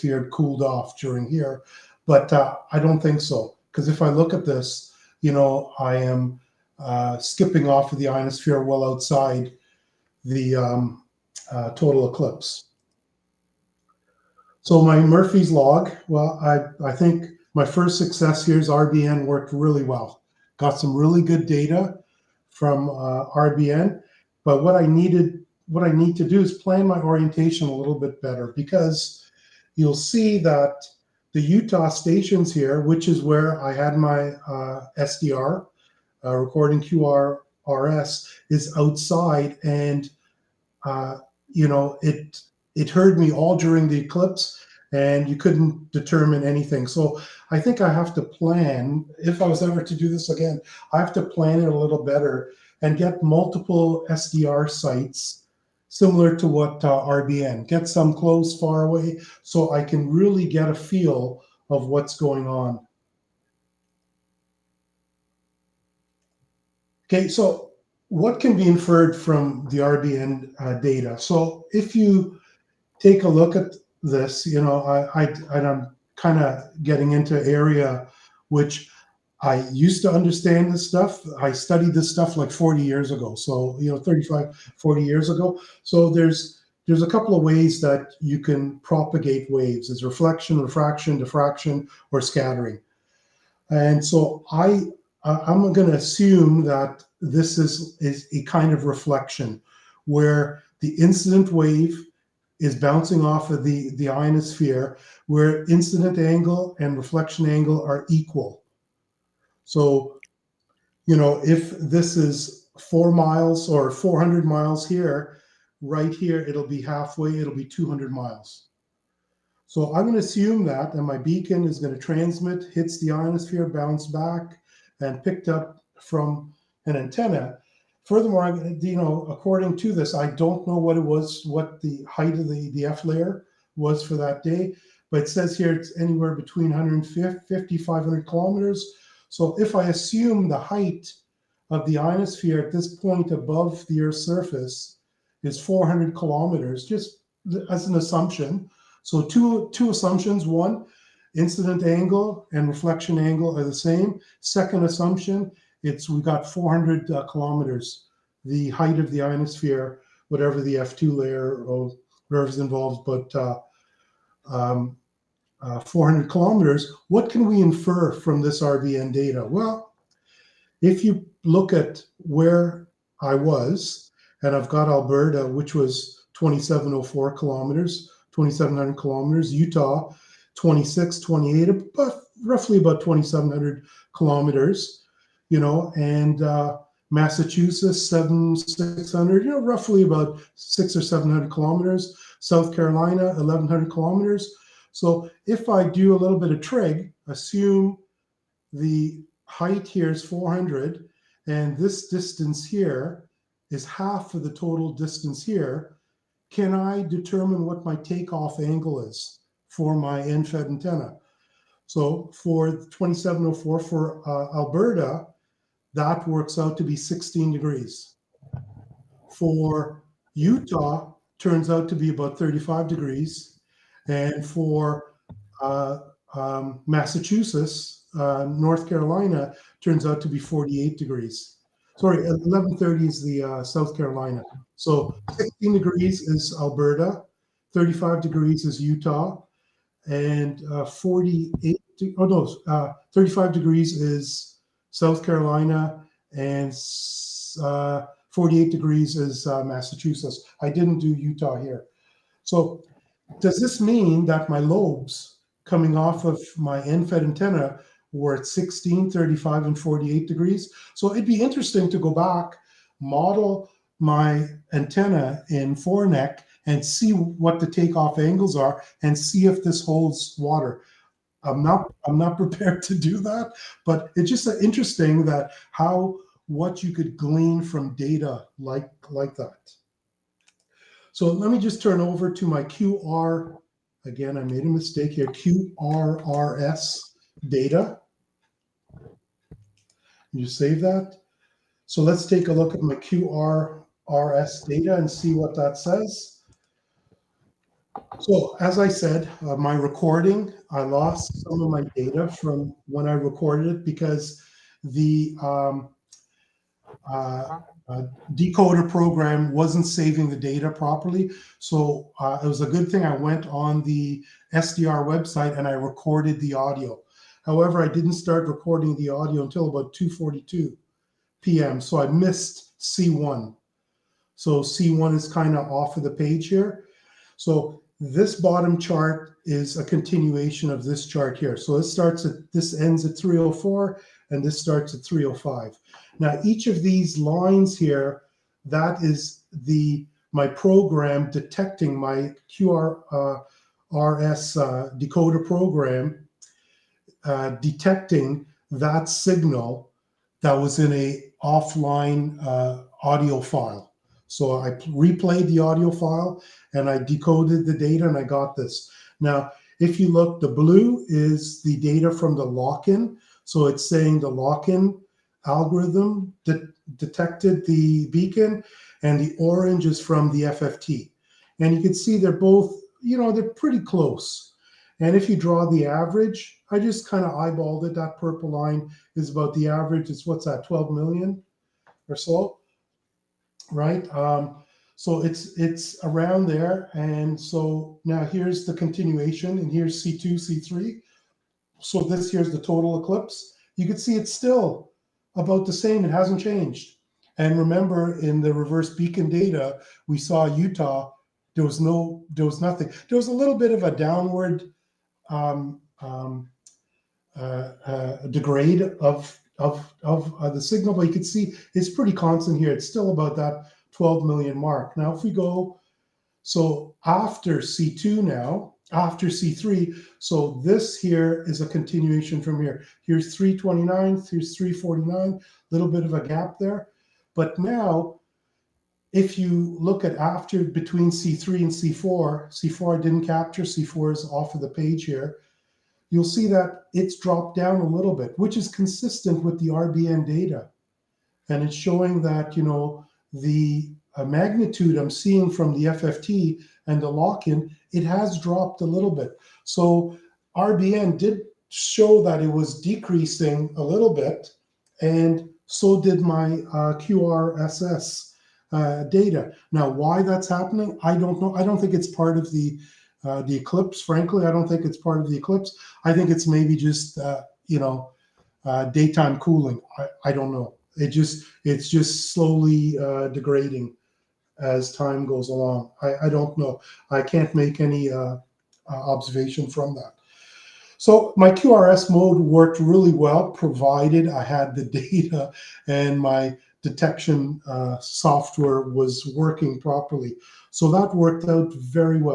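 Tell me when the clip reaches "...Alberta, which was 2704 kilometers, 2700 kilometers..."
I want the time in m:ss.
2:54.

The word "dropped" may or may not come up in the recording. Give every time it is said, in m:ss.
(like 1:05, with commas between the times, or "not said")
7:17, 7:28.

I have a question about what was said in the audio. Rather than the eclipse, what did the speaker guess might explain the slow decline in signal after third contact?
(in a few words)
daytime cooling.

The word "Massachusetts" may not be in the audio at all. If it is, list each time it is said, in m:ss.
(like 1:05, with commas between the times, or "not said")
3:07, 3:46, 4:09.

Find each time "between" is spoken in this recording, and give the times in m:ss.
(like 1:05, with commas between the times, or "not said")
2:16, 7:10.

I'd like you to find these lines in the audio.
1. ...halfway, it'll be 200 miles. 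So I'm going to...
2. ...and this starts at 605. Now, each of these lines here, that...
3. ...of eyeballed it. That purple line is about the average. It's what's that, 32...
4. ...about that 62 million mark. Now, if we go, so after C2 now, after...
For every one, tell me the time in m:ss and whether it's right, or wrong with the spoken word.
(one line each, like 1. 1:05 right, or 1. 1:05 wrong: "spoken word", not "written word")
1. 1:56 right
2. 5:34 wrong: "305", not "605"
3. 6:17 wrong: "12", not "32"
4. 6:53 wrong: "12", not "62".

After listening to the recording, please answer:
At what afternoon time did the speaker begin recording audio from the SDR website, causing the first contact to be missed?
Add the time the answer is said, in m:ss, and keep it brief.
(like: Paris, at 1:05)
2:42 p.m., at 5:19.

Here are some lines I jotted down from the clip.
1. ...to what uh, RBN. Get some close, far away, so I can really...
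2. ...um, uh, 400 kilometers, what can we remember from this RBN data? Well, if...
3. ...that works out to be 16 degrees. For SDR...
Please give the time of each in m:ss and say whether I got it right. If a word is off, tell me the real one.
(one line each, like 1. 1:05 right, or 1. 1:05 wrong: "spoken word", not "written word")
1. 0:56 right
2. 2:44 wrong: "infer", not "remember"
3. 3:35 wrong: "Utah", not "SDR".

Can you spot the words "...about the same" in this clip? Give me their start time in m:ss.
6:35.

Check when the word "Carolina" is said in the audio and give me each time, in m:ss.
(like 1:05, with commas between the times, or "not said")
3:12, 3:48, 3:53, 4:05.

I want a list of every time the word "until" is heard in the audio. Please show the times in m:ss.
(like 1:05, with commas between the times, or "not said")
5:19.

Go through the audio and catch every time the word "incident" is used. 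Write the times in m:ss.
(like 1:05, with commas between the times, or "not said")
1:41, 1:45, 2:31.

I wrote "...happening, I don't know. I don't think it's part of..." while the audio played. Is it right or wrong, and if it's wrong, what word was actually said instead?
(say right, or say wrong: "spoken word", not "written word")
right.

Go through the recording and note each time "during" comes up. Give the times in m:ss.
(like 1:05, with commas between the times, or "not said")
0:00, 0:43.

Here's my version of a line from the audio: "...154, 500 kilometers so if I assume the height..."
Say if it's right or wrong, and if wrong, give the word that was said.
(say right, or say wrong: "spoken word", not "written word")
wrong: "150", not "154".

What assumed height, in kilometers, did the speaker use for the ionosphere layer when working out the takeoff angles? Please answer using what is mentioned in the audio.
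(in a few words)
400.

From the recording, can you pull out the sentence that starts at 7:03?
Here's 329, here's 349, little bit of a gap there.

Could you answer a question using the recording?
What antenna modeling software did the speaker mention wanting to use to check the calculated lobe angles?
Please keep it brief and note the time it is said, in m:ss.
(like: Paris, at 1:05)
4NEC, at 4:25.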